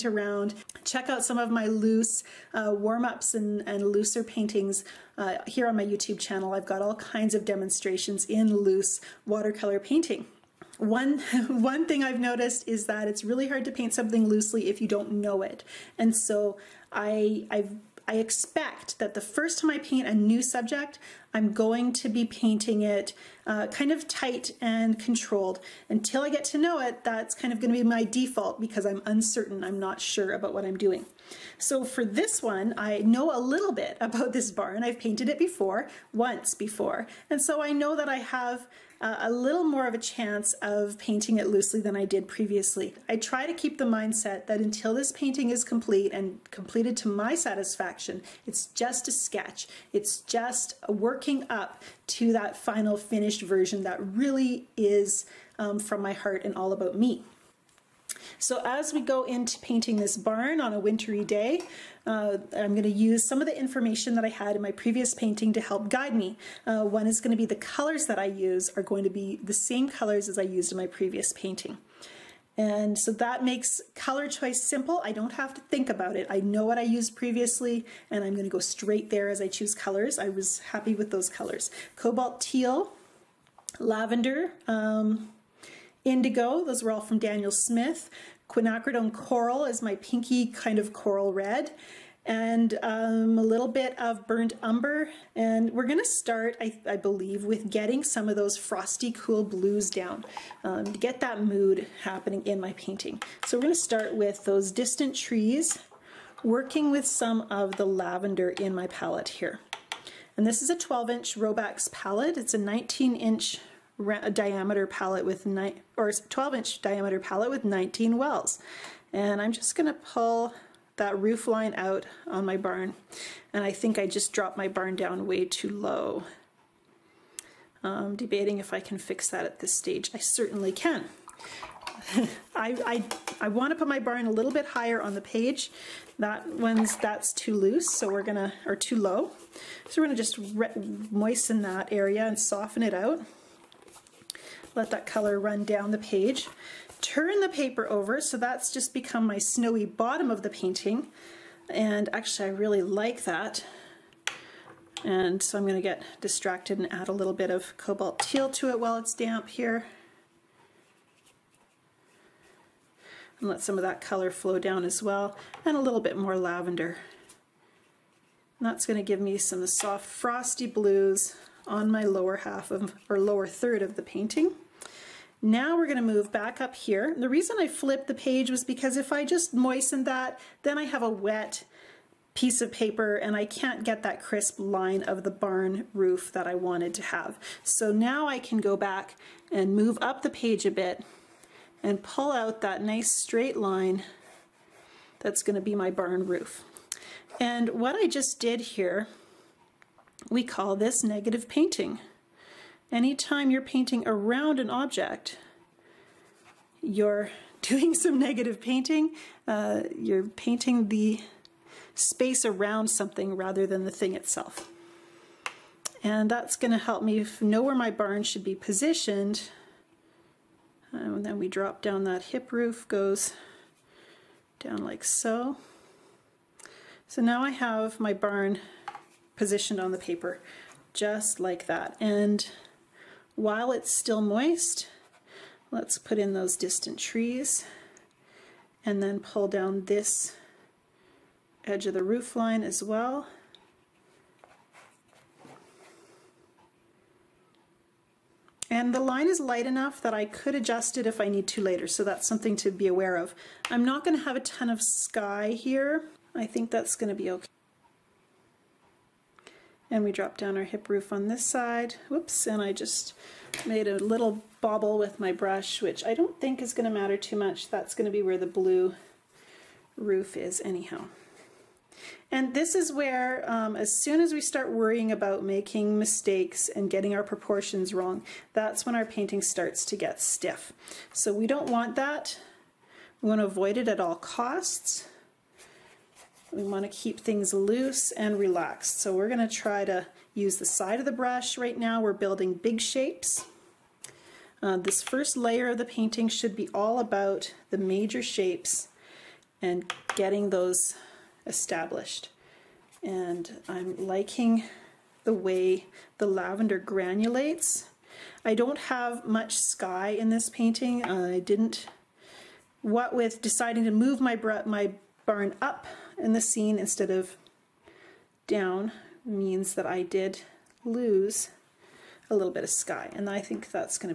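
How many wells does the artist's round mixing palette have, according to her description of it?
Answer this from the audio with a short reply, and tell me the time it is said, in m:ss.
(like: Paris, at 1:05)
19, at 1:57.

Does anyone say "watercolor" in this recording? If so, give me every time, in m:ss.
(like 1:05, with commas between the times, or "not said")
0:09.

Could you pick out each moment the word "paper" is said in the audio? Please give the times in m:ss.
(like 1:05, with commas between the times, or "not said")
2:27, 3:02, 3:49.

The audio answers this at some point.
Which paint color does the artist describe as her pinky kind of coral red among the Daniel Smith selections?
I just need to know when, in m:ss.
1:28.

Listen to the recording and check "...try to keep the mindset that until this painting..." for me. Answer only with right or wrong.
right.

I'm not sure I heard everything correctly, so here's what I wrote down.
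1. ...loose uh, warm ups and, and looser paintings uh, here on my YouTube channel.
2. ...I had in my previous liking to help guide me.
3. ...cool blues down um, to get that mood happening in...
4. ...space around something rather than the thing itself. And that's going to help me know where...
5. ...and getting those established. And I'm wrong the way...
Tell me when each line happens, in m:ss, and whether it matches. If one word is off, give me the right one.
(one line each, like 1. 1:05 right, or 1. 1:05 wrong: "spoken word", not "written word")
1. 0:01 right
2. 1:04 wrong: "painting", not "liking"
3. 1:39 right
4. 3:31 right
5. 4:59 wrong: "liking", not "wrong".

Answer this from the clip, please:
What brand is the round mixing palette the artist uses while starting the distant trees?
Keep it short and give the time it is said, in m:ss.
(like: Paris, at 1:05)
Robax, at 1:51.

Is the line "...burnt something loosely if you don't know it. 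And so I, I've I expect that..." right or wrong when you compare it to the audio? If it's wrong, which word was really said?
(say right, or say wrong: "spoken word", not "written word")
wrong: "paint", not "burnt".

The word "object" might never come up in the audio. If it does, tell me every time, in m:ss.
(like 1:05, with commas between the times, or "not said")
3:24.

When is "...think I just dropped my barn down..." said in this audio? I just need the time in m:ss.
2:03.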